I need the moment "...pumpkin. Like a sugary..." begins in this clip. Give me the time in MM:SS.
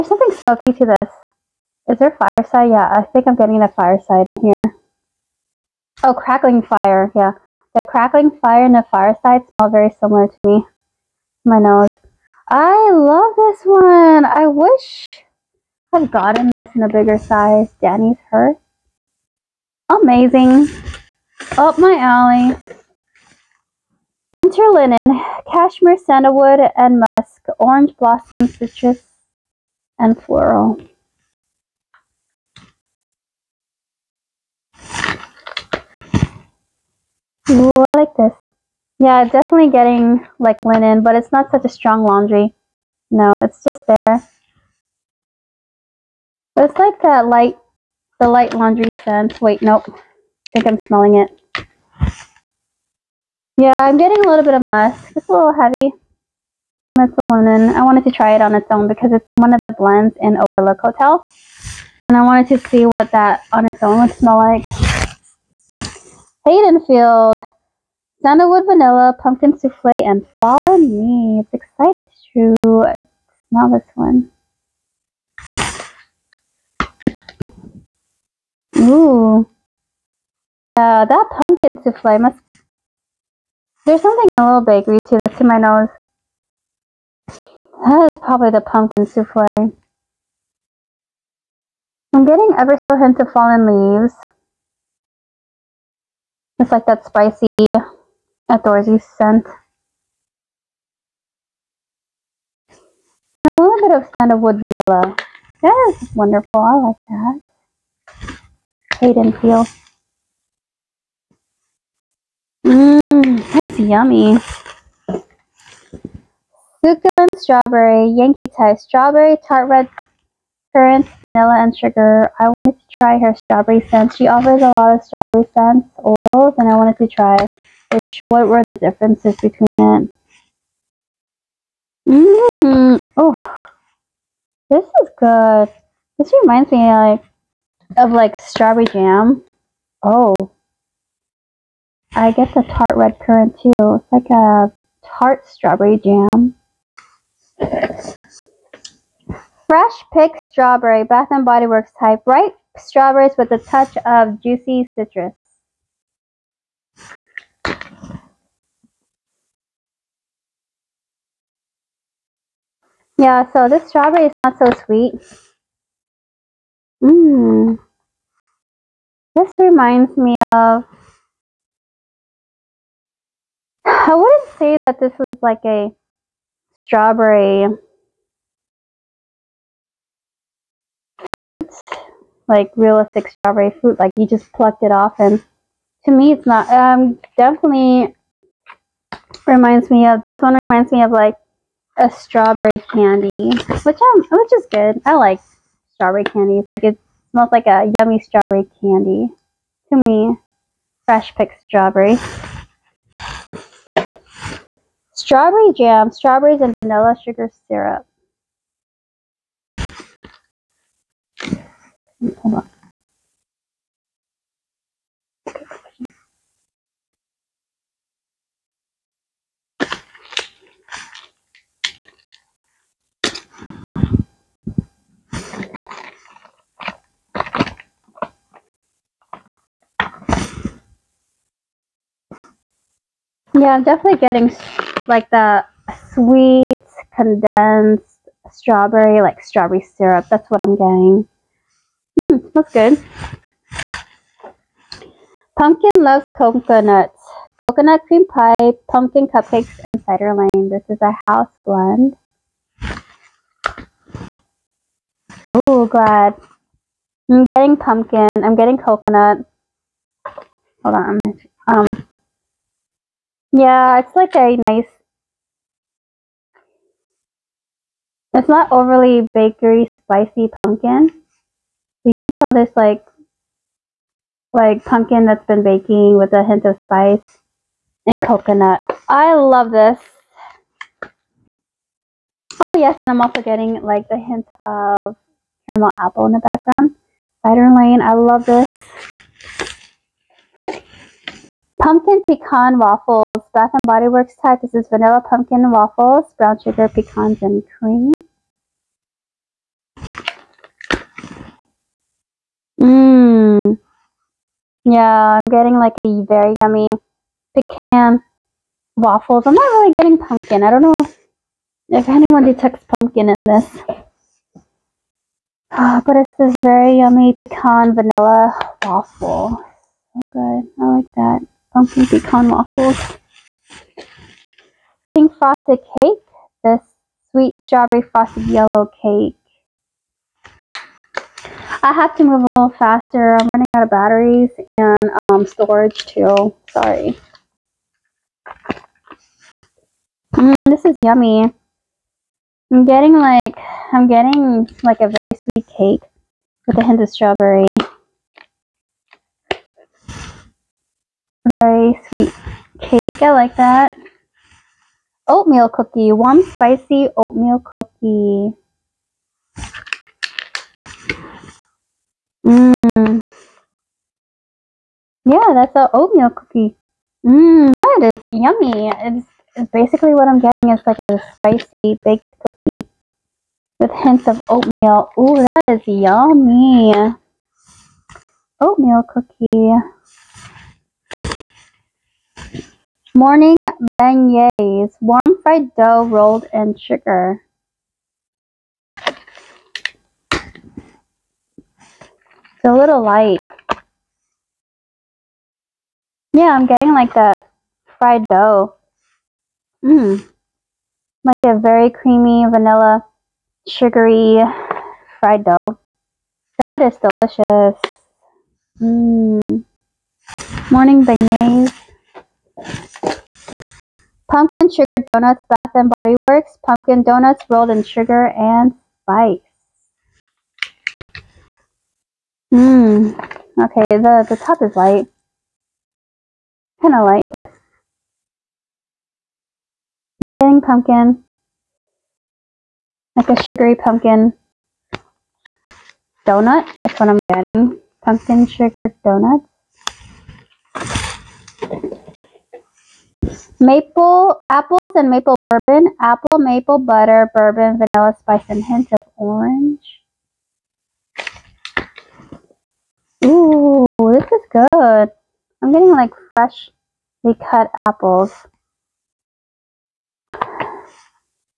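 07:10.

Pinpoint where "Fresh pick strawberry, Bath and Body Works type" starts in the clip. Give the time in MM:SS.
02:29.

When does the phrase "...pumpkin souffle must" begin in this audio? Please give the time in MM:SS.
01:21.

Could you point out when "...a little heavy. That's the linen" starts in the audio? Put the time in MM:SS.
00:55.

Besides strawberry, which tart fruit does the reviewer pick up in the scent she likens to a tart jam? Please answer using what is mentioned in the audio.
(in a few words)
tart red currants.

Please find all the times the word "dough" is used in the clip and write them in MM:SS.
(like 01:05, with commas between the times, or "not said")
06:25, 06:38, 06:45.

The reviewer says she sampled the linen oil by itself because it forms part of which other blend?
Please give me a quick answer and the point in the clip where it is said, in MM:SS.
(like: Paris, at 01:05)
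Overlook Hotel, at 01:00.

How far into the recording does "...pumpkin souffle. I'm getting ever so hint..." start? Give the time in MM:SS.
01:28.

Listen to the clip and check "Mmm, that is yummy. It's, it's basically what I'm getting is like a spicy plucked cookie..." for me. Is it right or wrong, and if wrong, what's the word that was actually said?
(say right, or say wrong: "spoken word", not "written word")
wrong: "baked", not "plucked".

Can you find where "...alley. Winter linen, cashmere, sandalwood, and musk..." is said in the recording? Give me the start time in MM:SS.
00:21.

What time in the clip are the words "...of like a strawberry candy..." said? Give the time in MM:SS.
03:11.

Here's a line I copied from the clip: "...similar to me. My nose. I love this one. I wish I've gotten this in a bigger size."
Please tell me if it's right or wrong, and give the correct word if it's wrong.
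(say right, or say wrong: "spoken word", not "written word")
right.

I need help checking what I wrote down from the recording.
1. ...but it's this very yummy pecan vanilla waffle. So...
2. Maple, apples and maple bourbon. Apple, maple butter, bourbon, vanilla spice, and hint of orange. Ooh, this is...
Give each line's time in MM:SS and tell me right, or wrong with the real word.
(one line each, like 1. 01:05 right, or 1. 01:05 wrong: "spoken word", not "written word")
1. 05:16 right
2. 07:23 right.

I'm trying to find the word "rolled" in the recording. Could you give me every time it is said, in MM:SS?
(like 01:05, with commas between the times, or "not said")
06:26, 06:57.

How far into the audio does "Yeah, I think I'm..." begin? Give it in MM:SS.
00:02.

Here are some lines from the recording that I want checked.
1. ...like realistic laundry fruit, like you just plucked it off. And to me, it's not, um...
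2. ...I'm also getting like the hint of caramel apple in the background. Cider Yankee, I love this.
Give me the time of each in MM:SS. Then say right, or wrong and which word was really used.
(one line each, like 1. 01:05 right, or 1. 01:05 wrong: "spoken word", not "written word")
1. 03:02 wrong: "strawberry", not "laundry"
2. 04:43 wrong: "Lane", not "Yankee".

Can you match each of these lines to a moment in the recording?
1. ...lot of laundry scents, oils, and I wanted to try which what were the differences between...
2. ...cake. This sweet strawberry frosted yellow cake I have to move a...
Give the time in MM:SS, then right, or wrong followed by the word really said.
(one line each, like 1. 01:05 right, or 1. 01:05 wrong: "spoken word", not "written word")
1. 02:04 wrong: "strawberry", not "laundry"
2. 05:25 right.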